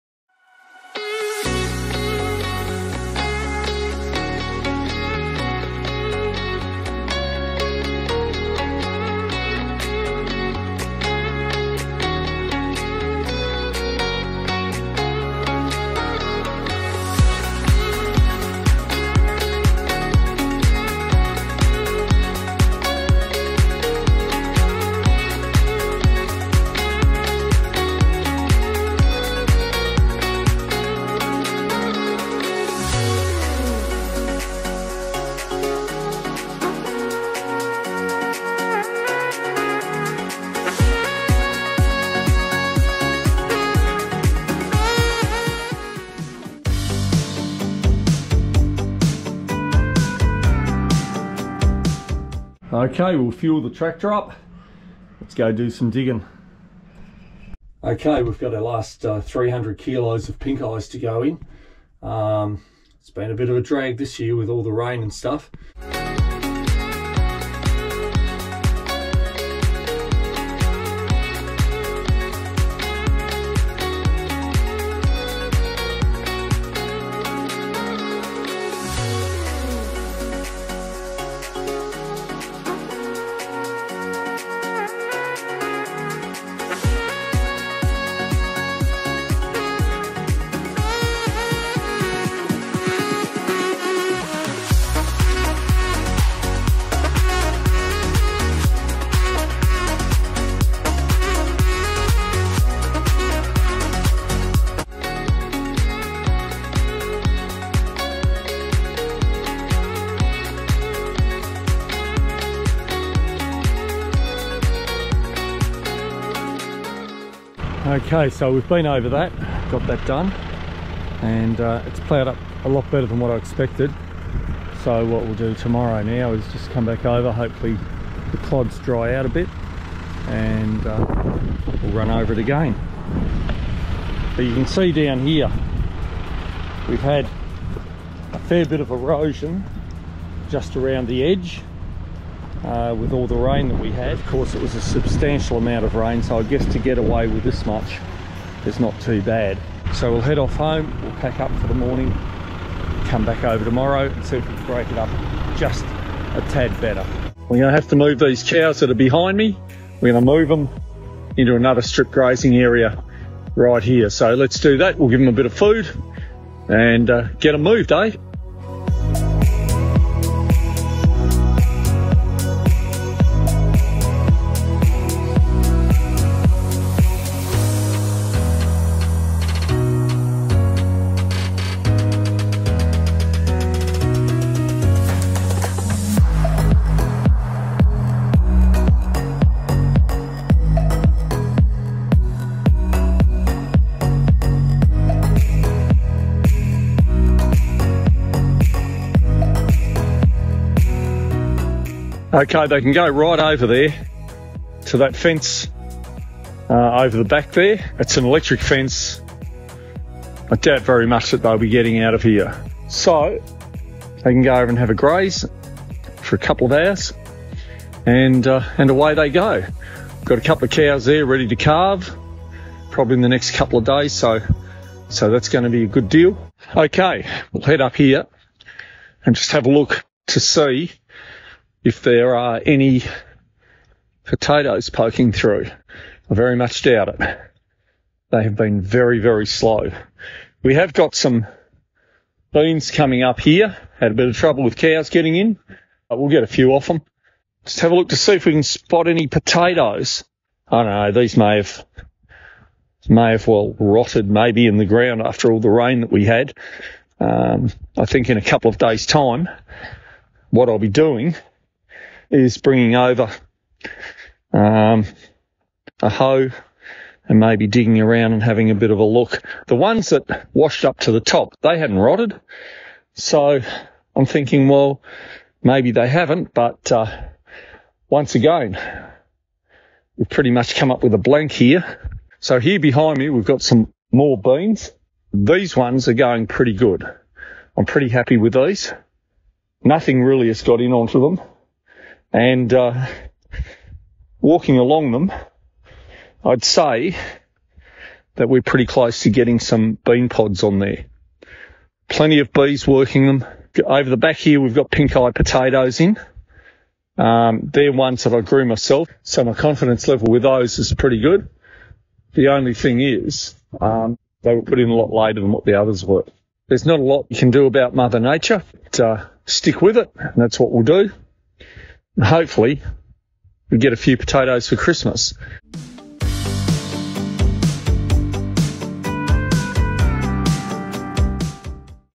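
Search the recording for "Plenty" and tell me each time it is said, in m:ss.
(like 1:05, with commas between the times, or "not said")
5:02.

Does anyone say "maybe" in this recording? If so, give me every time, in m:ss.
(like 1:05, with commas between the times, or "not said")
4:14, 4:27, 4:35.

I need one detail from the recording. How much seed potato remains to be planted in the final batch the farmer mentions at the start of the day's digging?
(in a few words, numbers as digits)
300 kilos.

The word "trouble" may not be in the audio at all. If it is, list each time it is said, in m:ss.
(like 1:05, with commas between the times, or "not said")
4:04.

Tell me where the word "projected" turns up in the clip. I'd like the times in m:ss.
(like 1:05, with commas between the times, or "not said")
not said.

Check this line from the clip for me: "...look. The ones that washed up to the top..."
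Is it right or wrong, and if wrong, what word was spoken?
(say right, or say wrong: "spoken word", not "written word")
right.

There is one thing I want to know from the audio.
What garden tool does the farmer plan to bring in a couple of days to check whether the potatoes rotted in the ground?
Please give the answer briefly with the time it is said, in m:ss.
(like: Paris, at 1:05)
A hoe, at 4:26.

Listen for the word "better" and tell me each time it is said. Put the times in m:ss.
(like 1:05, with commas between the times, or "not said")
2:02, 2:36.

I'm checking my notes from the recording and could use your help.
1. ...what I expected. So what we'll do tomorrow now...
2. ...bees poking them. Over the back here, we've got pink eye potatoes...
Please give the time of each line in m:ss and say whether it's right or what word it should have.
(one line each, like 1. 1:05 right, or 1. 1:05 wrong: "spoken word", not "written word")
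1. 2:03 right
2. 5:02 wrong: "working", not "poking".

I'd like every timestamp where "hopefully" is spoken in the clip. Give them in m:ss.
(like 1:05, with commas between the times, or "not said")
2:07, 5:22.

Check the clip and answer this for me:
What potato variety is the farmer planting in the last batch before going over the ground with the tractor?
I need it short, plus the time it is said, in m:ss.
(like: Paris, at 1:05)
Pink eyes, at 1:00.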